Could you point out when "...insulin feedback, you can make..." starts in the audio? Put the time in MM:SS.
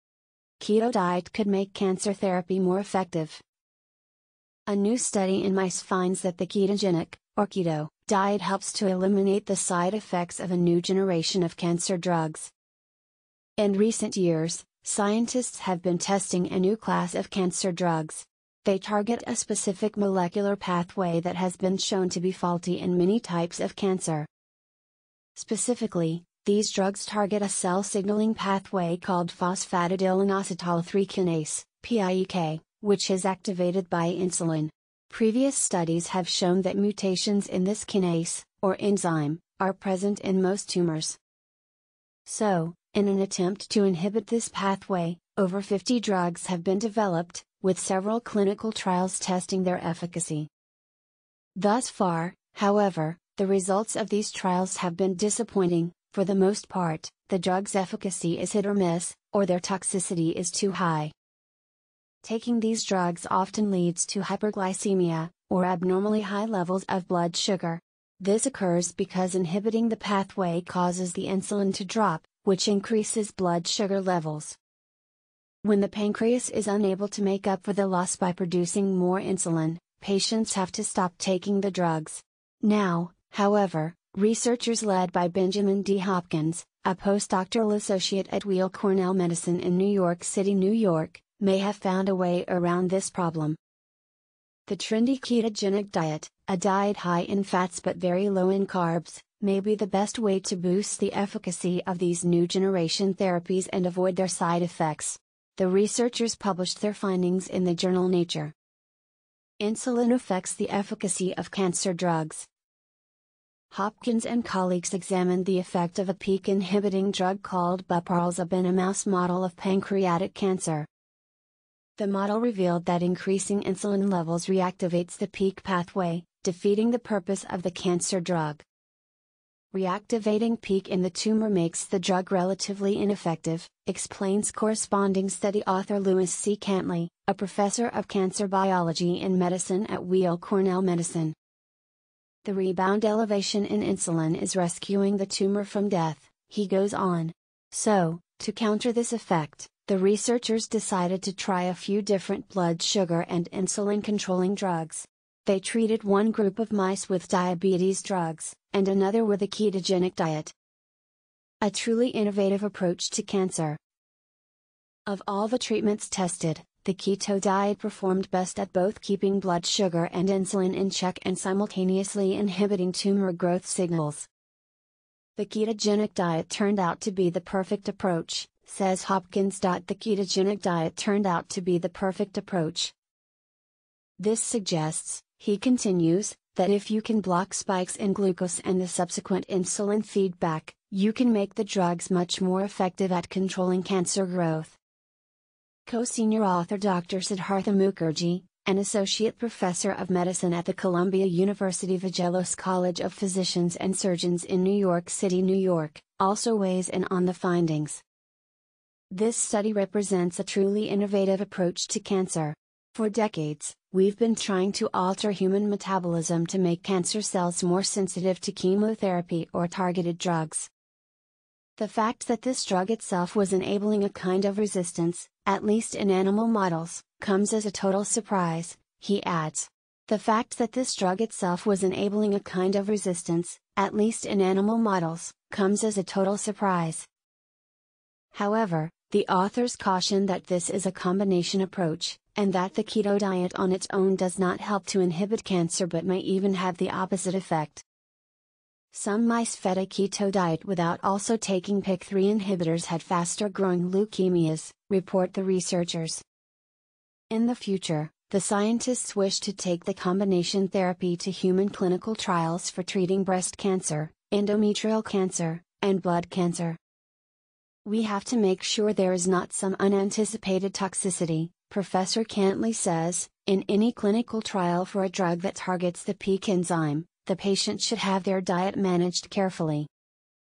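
03:09.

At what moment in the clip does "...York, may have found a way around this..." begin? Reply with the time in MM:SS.
01:30.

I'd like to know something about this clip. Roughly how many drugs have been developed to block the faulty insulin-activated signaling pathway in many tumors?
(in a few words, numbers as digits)
over 50.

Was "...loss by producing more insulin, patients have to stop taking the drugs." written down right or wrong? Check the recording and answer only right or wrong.
right.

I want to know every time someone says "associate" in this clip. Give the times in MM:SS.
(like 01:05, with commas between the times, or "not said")
01:27, 03:18.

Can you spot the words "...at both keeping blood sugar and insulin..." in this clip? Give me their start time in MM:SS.
02:48.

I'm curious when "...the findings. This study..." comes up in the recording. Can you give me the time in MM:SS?
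03:27.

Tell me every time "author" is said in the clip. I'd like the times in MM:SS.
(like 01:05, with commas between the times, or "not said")
02:15, 03:16, 03:59.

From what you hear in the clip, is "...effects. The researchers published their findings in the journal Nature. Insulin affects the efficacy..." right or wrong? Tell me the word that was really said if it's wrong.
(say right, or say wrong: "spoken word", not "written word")
right.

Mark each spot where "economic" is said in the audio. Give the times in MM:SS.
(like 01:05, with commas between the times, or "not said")
not said.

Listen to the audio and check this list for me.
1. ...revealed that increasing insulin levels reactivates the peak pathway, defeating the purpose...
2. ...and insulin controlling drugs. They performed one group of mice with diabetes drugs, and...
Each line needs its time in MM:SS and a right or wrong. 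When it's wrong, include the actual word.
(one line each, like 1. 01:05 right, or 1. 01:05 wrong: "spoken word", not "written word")
1. 02:02 right
2. 02:33 wrong: "treated", not "performed".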